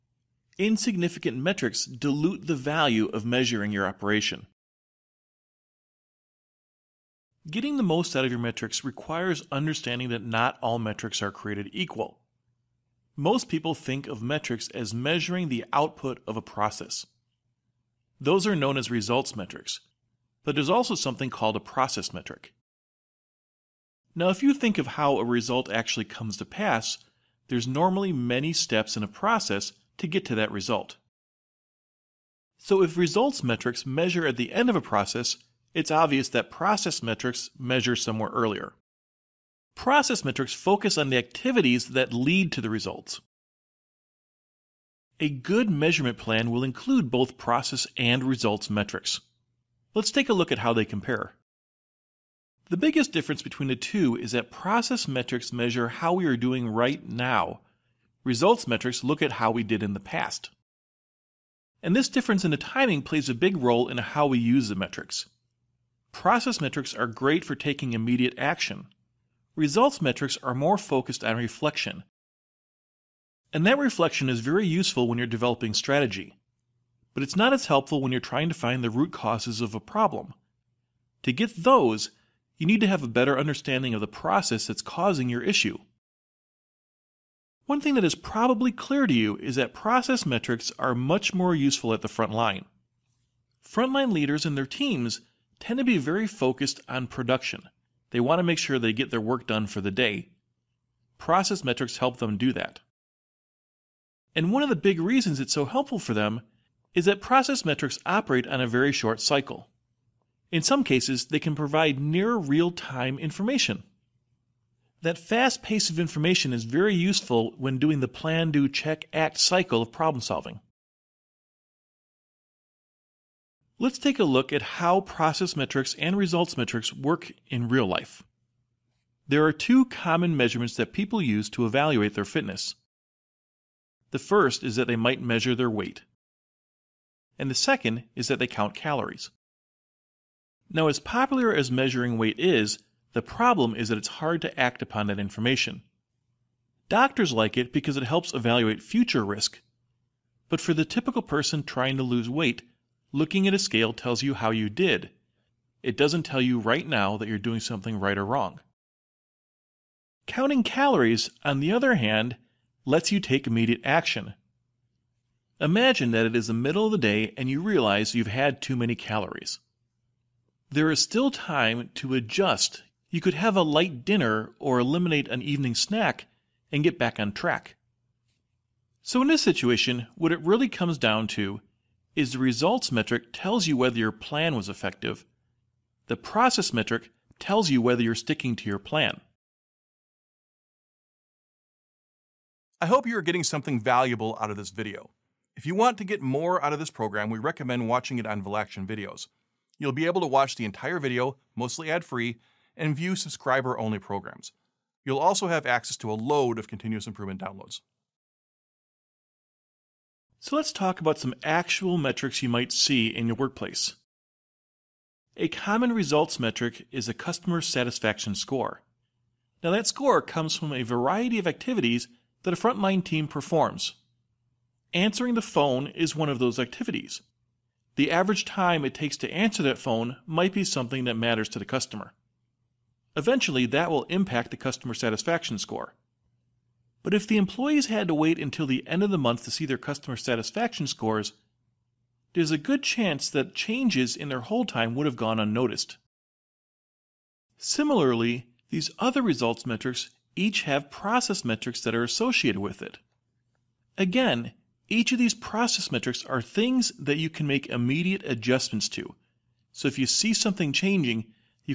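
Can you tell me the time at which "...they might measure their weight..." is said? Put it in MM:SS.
02:14.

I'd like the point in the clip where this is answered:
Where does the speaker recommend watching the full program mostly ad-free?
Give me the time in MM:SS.
03:18.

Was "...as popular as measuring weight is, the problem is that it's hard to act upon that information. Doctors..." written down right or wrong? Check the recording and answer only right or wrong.
right.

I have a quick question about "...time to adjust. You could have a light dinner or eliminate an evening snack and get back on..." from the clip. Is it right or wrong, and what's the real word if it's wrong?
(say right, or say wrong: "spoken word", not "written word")
right.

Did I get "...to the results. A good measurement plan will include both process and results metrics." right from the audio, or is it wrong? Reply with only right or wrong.
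right.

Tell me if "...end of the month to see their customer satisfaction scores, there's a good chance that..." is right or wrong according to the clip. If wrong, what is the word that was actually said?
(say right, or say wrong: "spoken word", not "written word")
right.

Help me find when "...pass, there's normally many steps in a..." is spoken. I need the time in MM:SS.
00:26.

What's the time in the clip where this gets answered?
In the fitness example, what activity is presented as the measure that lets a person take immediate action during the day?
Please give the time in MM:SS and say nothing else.
02:40.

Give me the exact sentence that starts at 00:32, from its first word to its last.
So if results metrics measure at the end of a process, it's obvious that process metrics measure somewhere earlier.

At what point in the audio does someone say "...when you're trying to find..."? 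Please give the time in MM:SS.
01:18.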